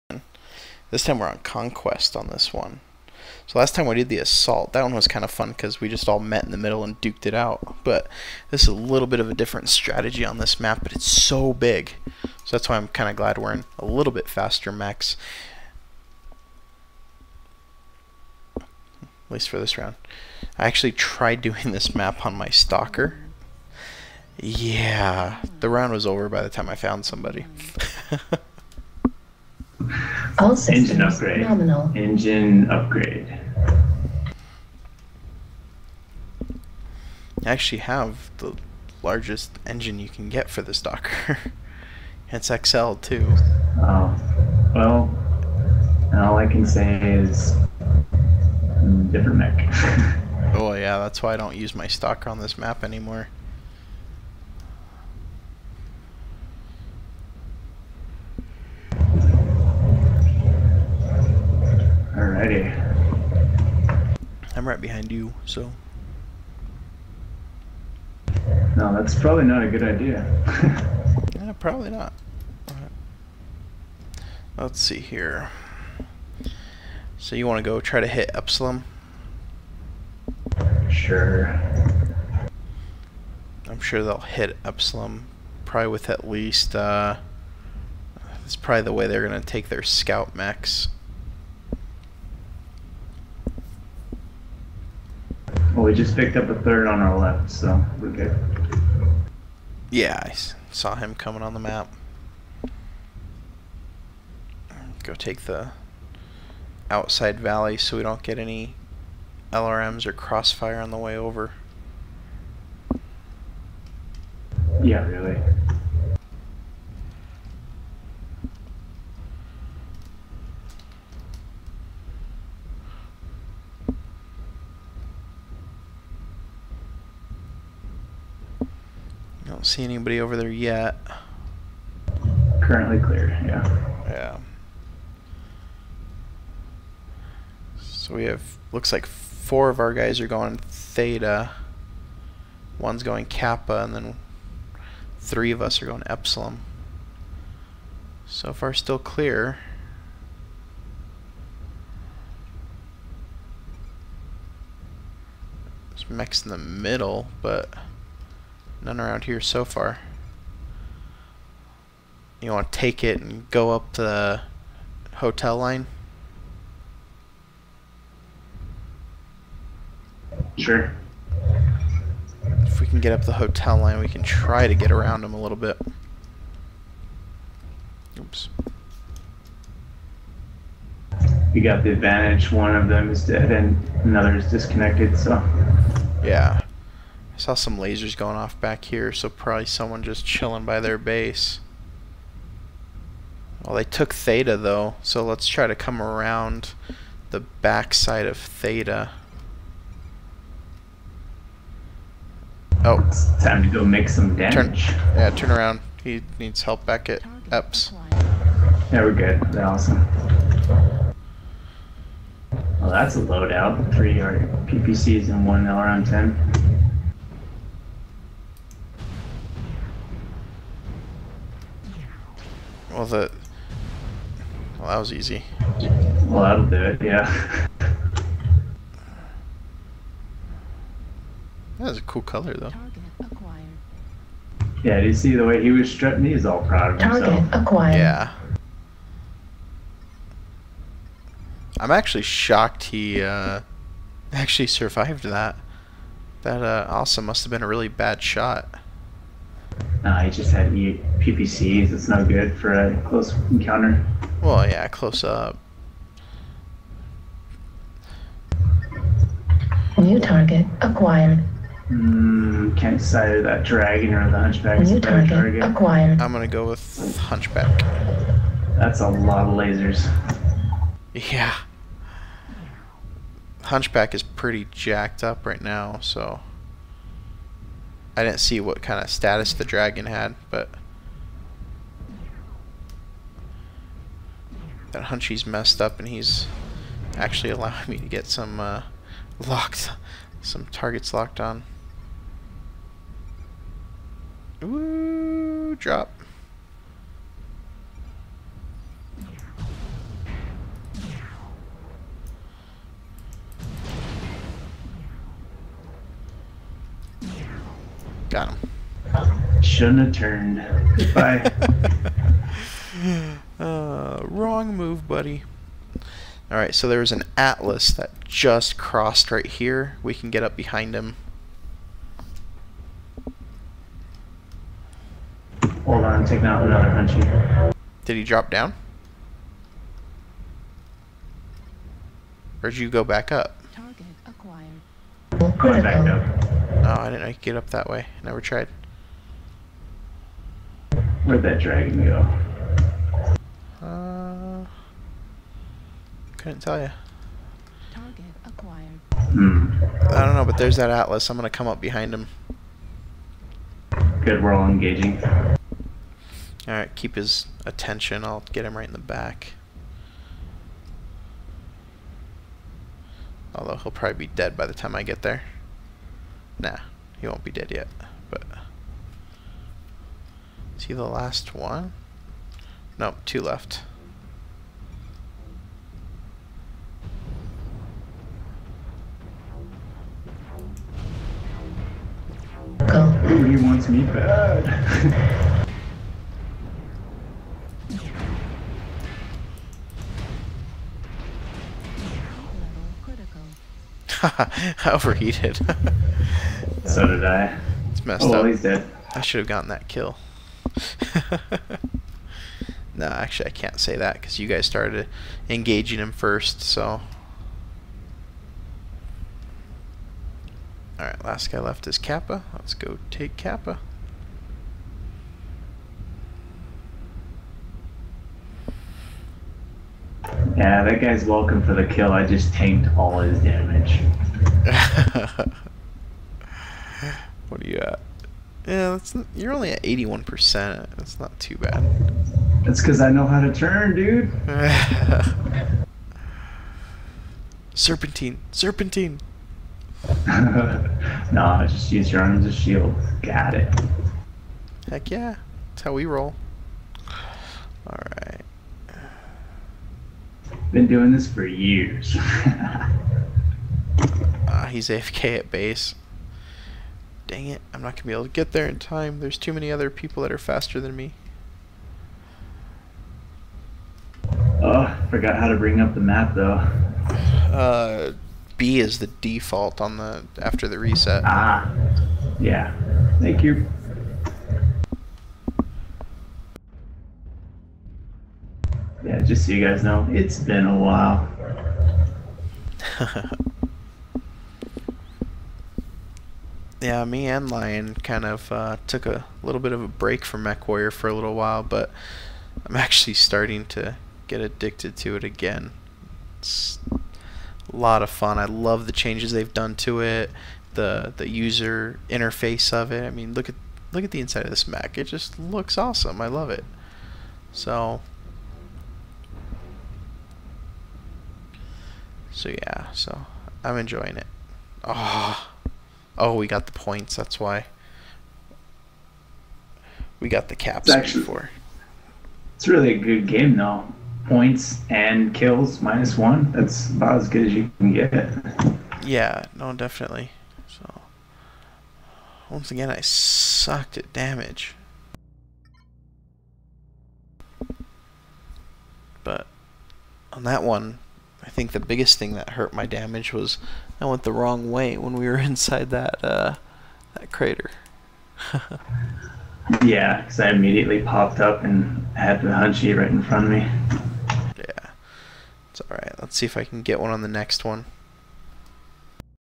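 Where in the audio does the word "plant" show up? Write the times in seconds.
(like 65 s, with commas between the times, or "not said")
not said.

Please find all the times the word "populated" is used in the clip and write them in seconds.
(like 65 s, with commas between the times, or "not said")
not said.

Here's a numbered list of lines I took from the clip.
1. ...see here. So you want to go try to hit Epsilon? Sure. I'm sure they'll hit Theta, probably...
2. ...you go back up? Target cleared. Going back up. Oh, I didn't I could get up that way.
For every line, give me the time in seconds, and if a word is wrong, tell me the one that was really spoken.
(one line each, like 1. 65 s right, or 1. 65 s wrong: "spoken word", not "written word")
1. 74 s wrong: "Epsilon", not "Theta"
2. 332 s wrong: "acquired", not "cleared".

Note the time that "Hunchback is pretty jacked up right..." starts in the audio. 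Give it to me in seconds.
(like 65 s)
273 s.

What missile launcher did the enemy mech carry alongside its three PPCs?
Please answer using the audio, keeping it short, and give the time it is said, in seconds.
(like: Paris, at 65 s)
LRM-10, at 215 s.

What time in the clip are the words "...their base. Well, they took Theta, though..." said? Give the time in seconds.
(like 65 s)
190 s.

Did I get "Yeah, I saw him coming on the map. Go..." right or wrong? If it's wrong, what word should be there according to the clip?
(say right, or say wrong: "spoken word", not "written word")
right.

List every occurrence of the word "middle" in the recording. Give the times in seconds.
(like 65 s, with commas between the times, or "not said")
6 s, 156 s.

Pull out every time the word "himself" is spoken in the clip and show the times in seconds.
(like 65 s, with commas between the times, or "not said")
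237 s.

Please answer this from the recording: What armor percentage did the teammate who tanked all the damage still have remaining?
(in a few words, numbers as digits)
81%.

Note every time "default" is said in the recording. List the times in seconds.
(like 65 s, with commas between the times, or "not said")
469 s.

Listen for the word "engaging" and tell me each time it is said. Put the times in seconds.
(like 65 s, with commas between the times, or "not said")
354 s, 405 s.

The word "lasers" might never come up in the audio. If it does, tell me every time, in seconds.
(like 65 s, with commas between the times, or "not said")
187 s, 269 s.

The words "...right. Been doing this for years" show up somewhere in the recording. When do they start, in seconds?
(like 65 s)
448 s.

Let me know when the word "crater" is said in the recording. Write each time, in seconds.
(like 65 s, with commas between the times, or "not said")
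547 s.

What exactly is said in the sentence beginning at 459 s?
There's too many other people that are faster than me.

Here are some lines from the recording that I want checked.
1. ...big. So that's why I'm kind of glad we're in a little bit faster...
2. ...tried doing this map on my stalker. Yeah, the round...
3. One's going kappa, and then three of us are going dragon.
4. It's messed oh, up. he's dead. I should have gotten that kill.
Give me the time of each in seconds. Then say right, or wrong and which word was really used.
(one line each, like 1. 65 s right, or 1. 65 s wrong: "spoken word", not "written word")
1. 11 s right
2. 20 s right
3. 142 s wrong: "epsilon", not "dragon"
4. 397 s right.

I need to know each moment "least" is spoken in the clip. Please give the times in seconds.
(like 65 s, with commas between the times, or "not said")
19 s, 86 s.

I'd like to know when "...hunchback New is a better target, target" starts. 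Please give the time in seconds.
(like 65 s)
264 s.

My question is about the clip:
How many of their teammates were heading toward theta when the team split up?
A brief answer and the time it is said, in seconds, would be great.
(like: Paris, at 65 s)
4, at 139 s.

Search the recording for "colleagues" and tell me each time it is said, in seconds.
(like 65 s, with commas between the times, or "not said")
not said.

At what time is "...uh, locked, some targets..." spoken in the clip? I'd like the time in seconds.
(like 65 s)
288 s.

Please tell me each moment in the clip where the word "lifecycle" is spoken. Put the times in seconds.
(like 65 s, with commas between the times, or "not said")
not said.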